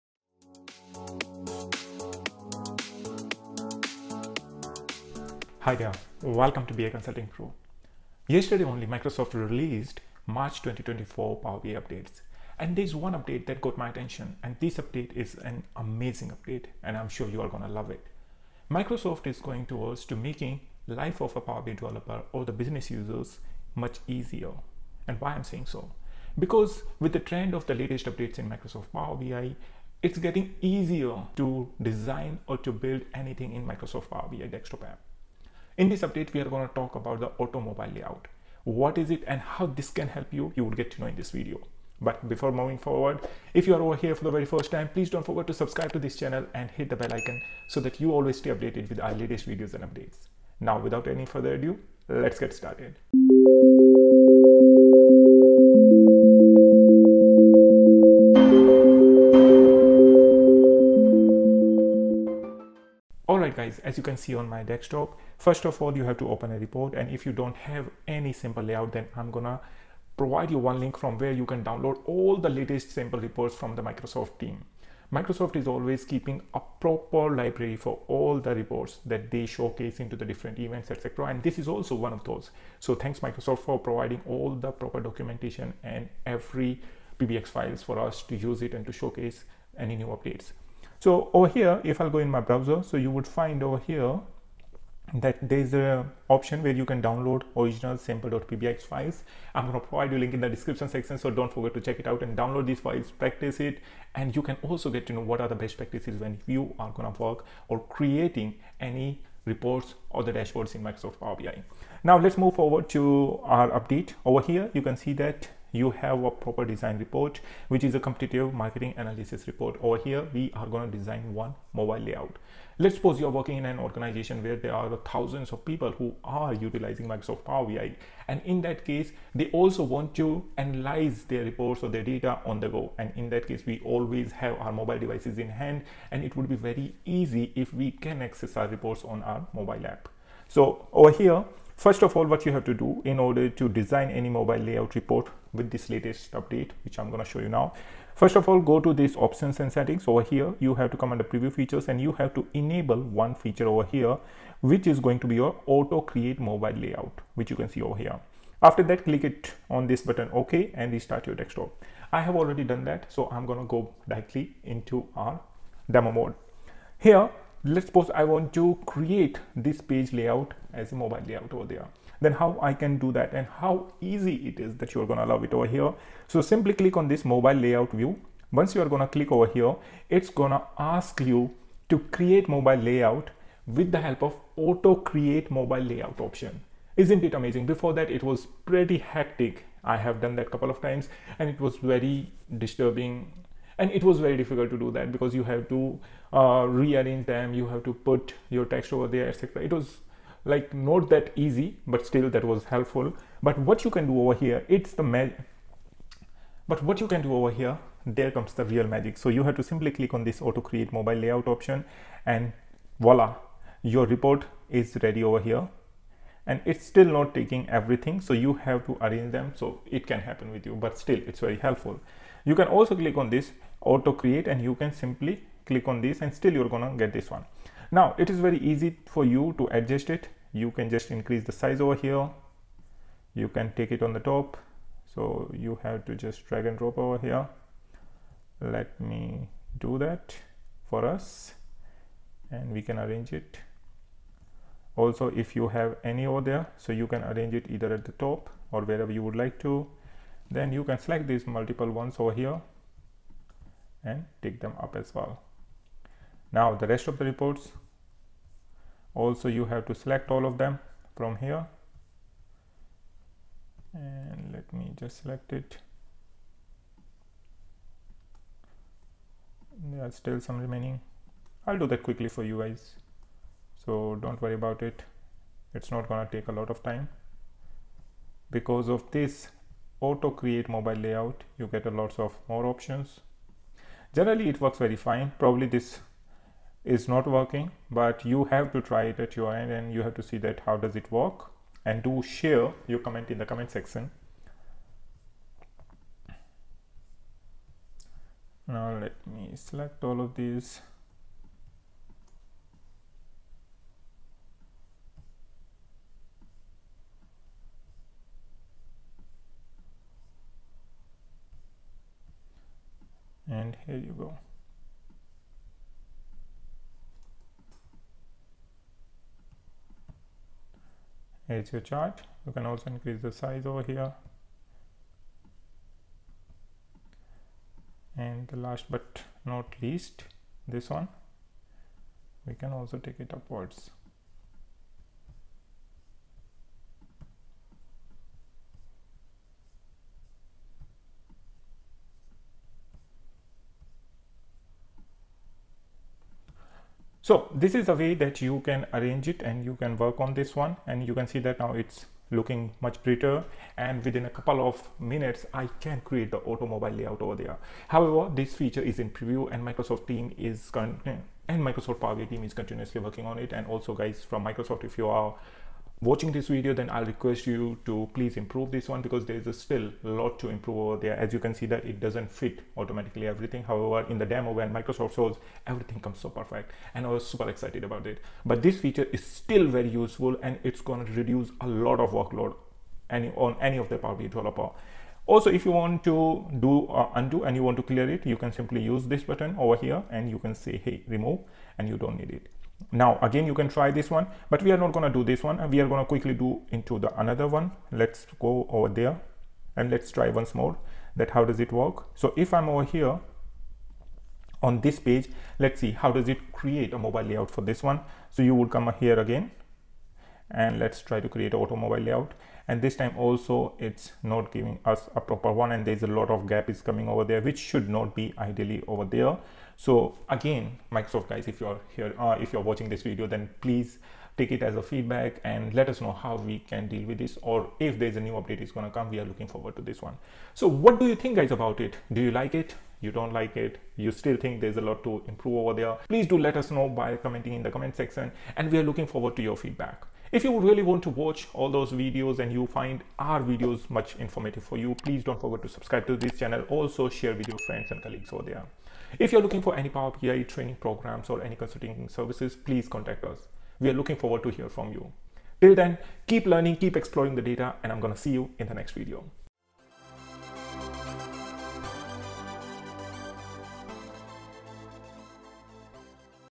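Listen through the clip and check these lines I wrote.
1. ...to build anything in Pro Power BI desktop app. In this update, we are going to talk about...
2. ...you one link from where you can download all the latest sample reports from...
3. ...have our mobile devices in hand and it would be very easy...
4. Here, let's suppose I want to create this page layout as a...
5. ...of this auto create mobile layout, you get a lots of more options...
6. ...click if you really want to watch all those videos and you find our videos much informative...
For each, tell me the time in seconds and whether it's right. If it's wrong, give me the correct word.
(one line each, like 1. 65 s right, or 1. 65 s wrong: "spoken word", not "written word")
1. 32 s wrong: "Microsoft", not "Pro"
2. 70 s right
3. 134 s right
4. 166 s right
5. 278 s right
6. 439 s wrong: "feedback", not "click".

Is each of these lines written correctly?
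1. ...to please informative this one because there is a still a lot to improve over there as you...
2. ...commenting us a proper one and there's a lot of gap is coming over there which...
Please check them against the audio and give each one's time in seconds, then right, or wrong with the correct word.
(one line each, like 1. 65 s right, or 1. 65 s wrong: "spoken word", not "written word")
1. 367 s wrong: "improve", not "informative"
2. 414 s wrong: "giving", not "commenting".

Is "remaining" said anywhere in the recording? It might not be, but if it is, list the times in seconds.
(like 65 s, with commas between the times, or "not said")
270 s.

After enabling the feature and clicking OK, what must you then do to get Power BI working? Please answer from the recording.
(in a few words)
restart your desktop.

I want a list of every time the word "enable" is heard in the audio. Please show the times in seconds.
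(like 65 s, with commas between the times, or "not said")
152 s.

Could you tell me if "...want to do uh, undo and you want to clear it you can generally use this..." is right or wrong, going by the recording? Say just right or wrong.
wrong.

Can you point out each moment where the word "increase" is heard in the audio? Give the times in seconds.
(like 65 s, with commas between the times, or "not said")
231 s, 322 s.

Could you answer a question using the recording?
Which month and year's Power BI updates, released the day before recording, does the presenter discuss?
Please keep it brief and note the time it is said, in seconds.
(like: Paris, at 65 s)
March 2024, at 10 s.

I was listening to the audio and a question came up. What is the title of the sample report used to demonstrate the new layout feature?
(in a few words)
competitive marketing analysis.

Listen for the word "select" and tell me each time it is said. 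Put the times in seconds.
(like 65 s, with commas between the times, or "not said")
250 s, 259 s, 265 s, 299 s.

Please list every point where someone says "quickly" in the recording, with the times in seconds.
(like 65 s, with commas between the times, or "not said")
272 s, 396 s.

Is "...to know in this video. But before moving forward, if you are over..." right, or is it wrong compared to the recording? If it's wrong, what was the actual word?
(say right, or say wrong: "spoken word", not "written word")
right.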